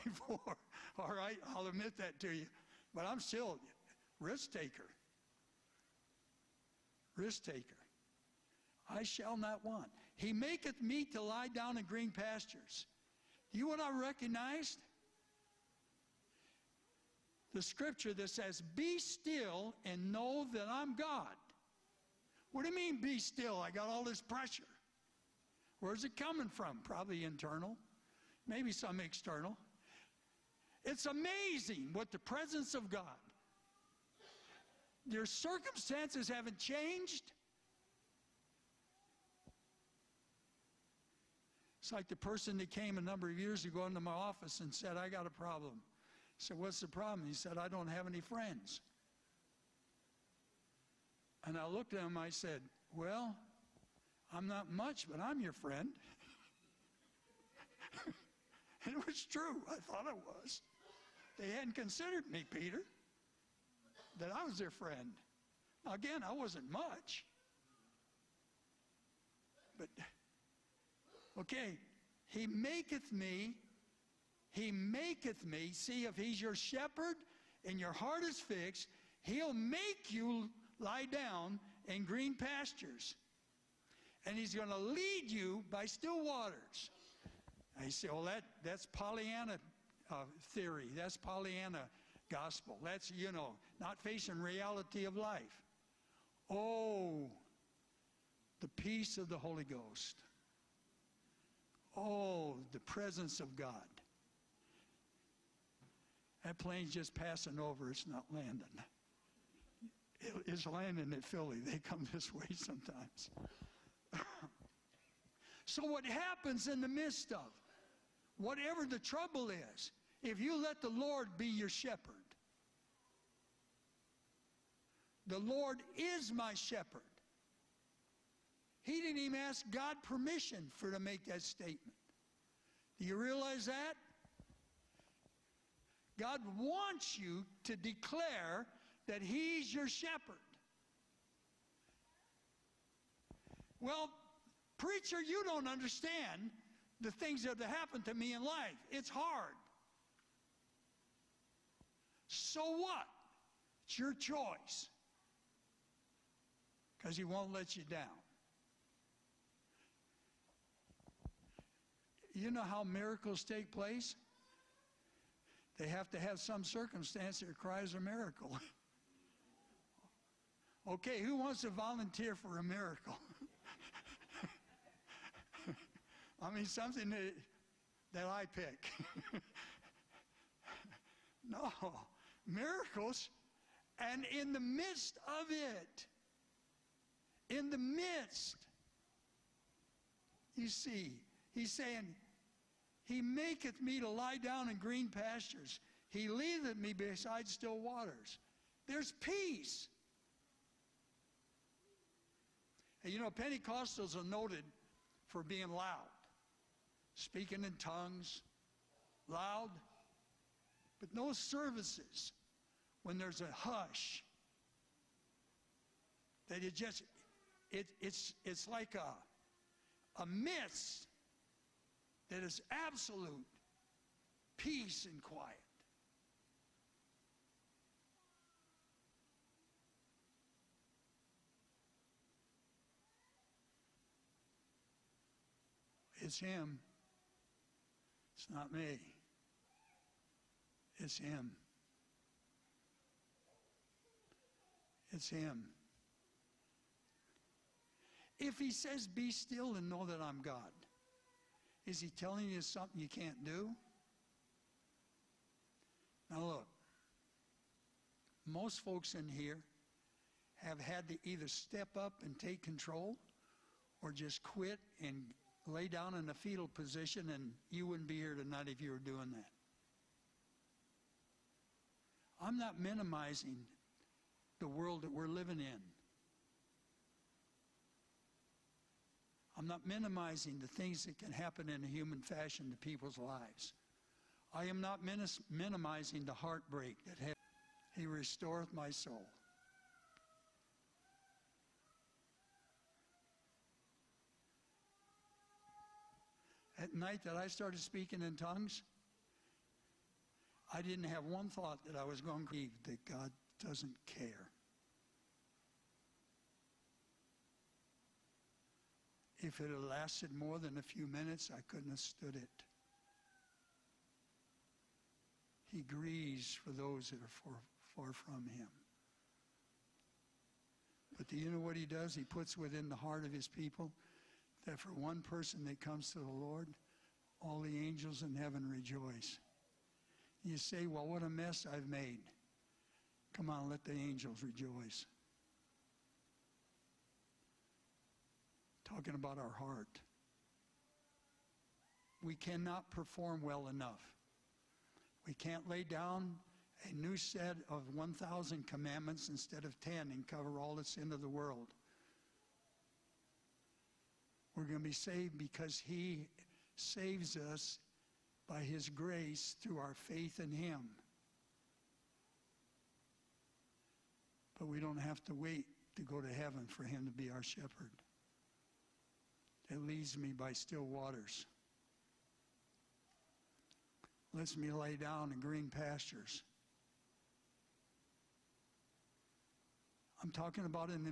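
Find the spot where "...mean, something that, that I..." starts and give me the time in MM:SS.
02:56.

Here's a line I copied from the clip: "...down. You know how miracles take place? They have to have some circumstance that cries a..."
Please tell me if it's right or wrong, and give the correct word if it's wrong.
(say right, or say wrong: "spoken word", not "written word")
right.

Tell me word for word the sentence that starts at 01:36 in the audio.
Oh, the peace of the Holy Ghost.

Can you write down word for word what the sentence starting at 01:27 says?
I say, well, that, that's Pollyanna uh, theory.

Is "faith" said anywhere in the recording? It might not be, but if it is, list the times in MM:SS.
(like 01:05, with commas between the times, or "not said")
05:59.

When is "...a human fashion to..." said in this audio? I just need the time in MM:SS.
04:41.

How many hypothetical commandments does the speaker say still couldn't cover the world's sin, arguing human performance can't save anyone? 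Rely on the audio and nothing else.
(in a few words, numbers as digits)
1000.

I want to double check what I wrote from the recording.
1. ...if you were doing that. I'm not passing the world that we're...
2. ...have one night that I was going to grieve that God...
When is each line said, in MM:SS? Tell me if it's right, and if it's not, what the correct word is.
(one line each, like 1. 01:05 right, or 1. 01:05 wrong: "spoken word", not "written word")
1. 04:28 wrong: "minimizing", not "passing"
2. 05:01 wrong: "thought", not "night".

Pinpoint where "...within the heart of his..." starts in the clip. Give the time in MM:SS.
05:22.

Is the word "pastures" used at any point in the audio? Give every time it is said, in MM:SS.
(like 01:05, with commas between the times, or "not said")
00:12, 01:22, 03:15, 06:15.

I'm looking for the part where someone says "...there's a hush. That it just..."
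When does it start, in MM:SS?
03:33.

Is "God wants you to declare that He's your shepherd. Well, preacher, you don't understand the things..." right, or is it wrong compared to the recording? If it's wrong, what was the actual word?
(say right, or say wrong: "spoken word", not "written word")
right.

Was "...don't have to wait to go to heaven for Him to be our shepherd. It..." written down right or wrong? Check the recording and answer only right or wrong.
right.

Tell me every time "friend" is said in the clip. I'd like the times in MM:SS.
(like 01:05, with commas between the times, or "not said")
00:48, 00:55, 01:04.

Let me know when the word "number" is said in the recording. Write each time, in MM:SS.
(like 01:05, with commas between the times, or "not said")
00:42.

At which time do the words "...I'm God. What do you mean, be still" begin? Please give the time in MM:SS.
00:20.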